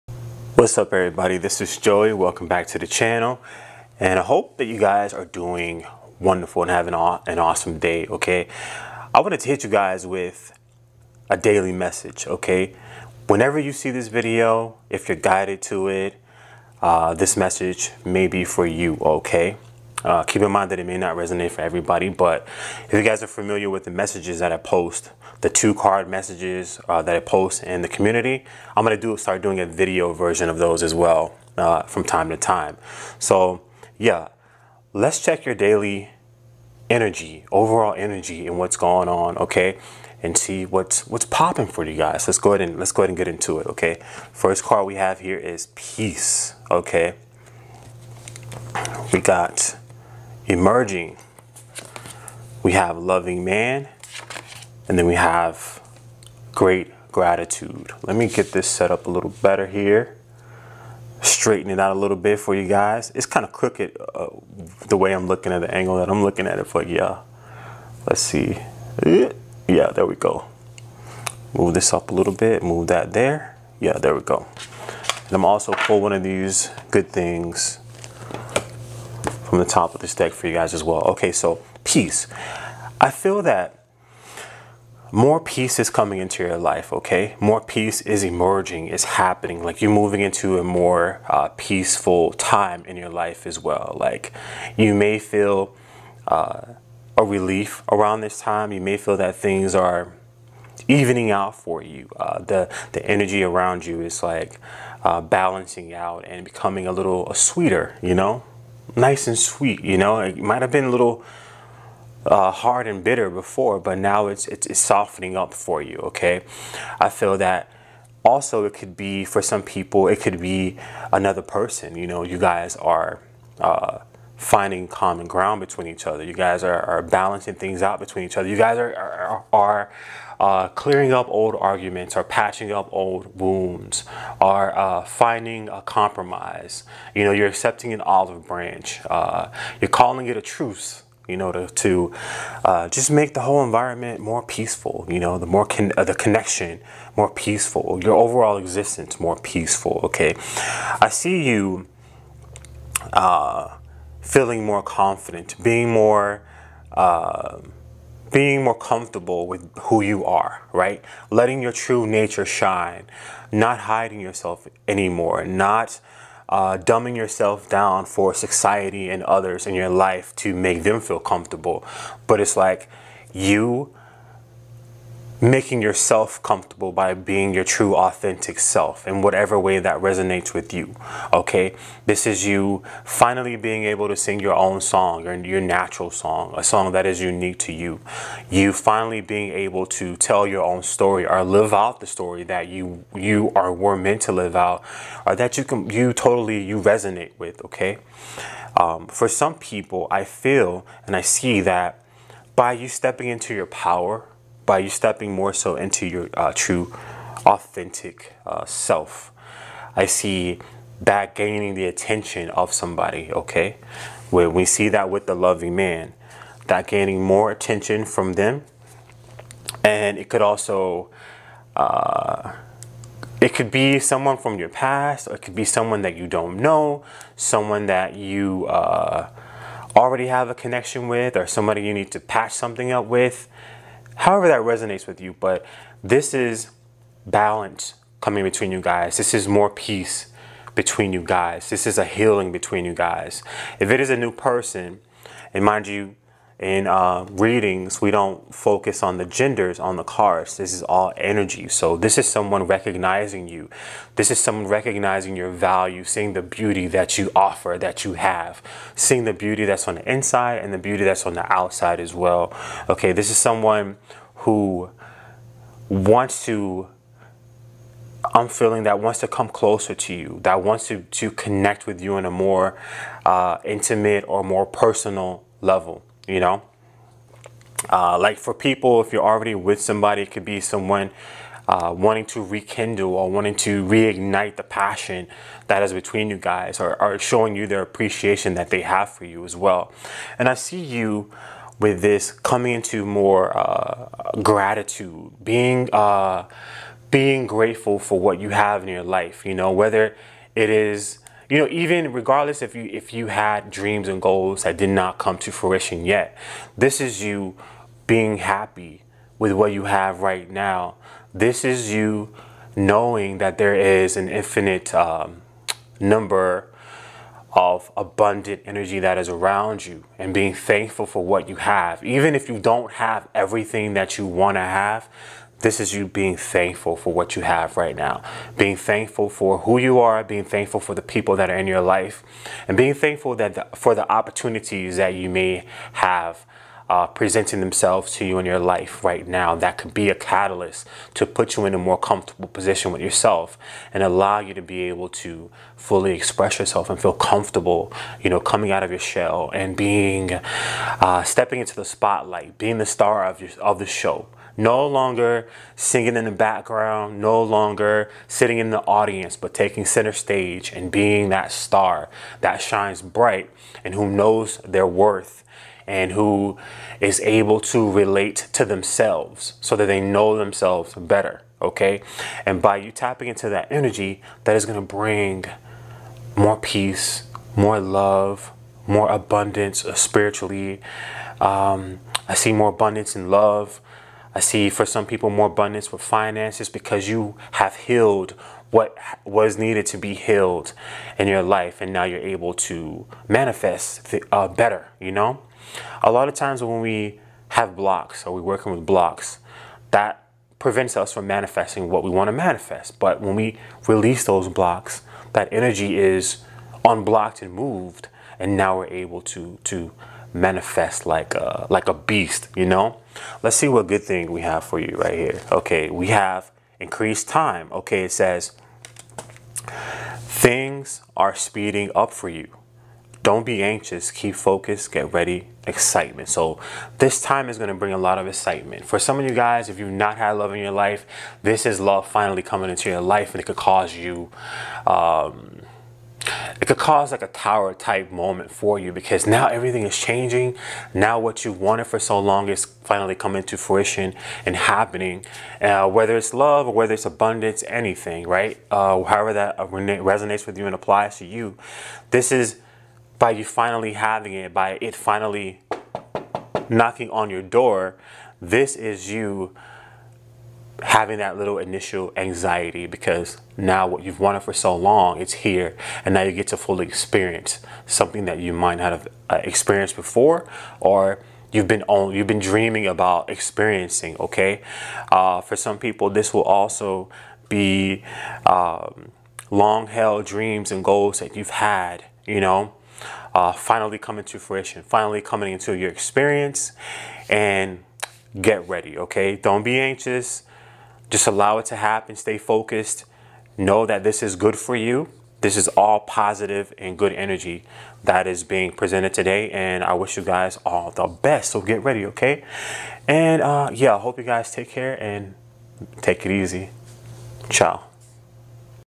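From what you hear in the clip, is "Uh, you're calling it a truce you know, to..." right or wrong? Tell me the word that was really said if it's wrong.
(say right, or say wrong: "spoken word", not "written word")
right.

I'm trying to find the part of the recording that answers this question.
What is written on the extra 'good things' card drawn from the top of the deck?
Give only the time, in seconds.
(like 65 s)
416 s.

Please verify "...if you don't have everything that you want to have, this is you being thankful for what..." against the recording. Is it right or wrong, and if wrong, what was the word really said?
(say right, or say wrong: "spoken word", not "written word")
right.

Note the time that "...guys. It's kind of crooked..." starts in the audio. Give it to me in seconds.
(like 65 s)
62 s.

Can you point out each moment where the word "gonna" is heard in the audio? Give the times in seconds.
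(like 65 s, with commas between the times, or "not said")
28 s.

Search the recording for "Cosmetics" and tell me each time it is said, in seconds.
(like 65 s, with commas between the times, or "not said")
not said.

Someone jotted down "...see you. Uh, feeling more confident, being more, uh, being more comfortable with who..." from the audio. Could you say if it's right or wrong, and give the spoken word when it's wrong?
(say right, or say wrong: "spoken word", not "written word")
right.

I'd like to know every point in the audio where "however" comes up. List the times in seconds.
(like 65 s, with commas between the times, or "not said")
234 s, 449 s.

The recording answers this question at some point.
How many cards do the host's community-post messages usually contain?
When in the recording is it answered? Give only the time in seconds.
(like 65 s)
25 s.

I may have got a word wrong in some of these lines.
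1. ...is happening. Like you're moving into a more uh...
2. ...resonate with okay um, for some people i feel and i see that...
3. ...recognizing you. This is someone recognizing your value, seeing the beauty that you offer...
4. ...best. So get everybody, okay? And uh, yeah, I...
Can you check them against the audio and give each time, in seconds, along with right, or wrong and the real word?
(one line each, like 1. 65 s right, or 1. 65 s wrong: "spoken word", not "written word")
1. 88 s right
2. 196 s right
3. 252 s right
4. 501 s wrong: "ready", not "everybody".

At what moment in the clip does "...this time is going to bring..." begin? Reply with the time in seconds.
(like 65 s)
426 s.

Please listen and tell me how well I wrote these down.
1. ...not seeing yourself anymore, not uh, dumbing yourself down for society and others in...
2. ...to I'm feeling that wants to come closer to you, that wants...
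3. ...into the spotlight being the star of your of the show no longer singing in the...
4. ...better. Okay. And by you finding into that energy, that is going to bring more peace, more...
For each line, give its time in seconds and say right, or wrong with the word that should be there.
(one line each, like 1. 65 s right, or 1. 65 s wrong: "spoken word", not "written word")
1. 163 s wrong: "hiding", not "seeing"
2. 266 s right
3. 351 s right
4. 370 s wrong: "tapping", not "finding".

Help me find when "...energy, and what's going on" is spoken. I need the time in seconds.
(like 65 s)
37 s.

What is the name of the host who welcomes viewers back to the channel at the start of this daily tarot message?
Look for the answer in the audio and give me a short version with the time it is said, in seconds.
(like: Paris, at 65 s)
Joey, at 1 s.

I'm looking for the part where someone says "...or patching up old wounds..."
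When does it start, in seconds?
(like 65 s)
132 s.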